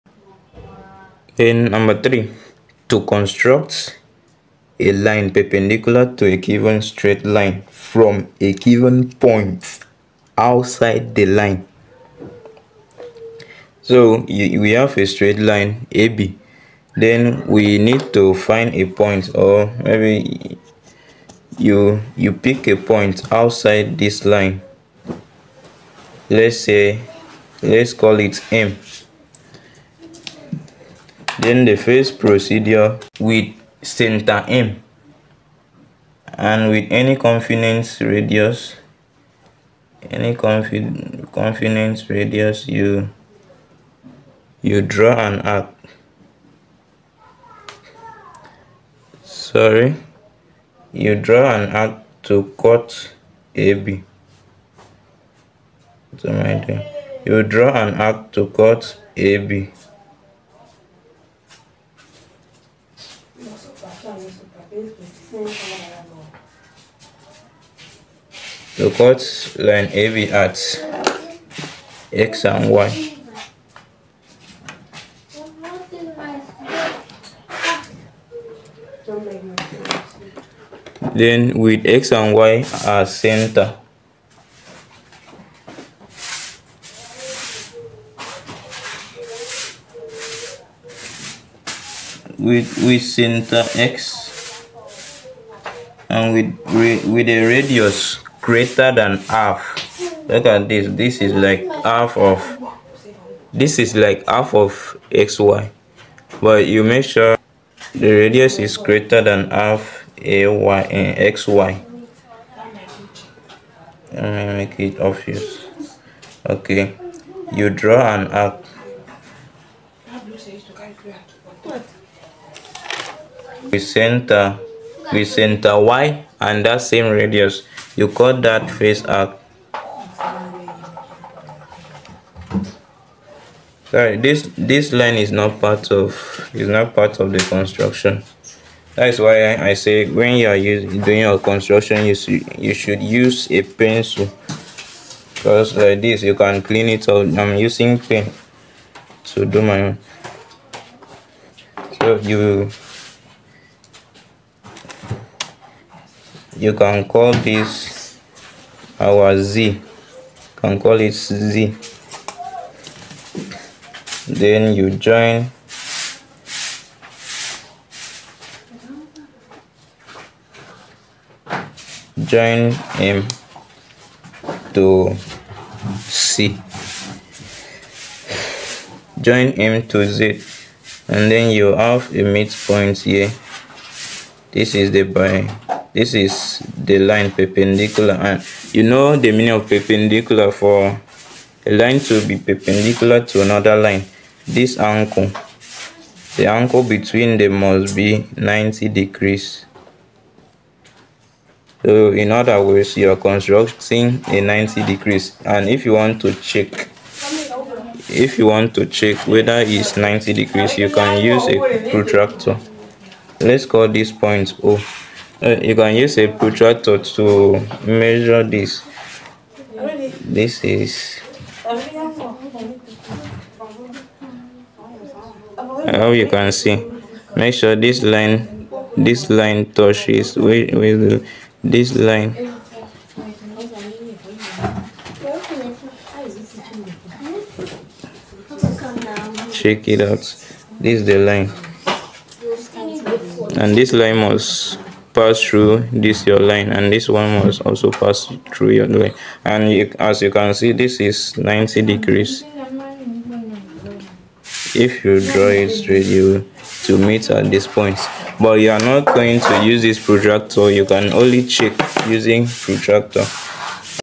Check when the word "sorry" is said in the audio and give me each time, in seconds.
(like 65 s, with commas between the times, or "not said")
49 s, 133 s.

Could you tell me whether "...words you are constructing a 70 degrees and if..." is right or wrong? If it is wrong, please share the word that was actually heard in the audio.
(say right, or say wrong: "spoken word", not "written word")
wrong: "90", not "70".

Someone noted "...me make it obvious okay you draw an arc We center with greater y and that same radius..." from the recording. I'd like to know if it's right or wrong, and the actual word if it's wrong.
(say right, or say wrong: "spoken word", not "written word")
wrong: "center", not "greater".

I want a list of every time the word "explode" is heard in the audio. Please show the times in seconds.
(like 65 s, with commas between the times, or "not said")
not said.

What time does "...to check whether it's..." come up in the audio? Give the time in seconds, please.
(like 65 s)
208 s.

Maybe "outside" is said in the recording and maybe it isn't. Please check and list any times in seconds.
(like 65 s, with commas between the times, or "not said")
10 s, 23 s.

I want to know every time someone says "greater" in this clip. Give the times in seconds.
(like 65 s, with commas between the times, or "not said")
98 s, 108 s.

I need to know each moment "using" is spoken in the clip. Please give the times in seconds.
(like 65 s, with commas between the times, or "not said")
140 s, 147 s, 262 s.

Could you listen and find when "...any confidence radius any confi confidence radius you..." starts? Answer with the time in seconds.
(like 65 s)
36 s.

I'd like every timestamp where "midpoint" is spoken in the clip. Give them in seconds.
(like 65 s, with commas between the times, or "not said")
182 s.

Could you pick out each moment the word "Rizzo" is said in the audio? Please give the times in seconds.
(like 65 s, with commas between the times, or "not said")
not said.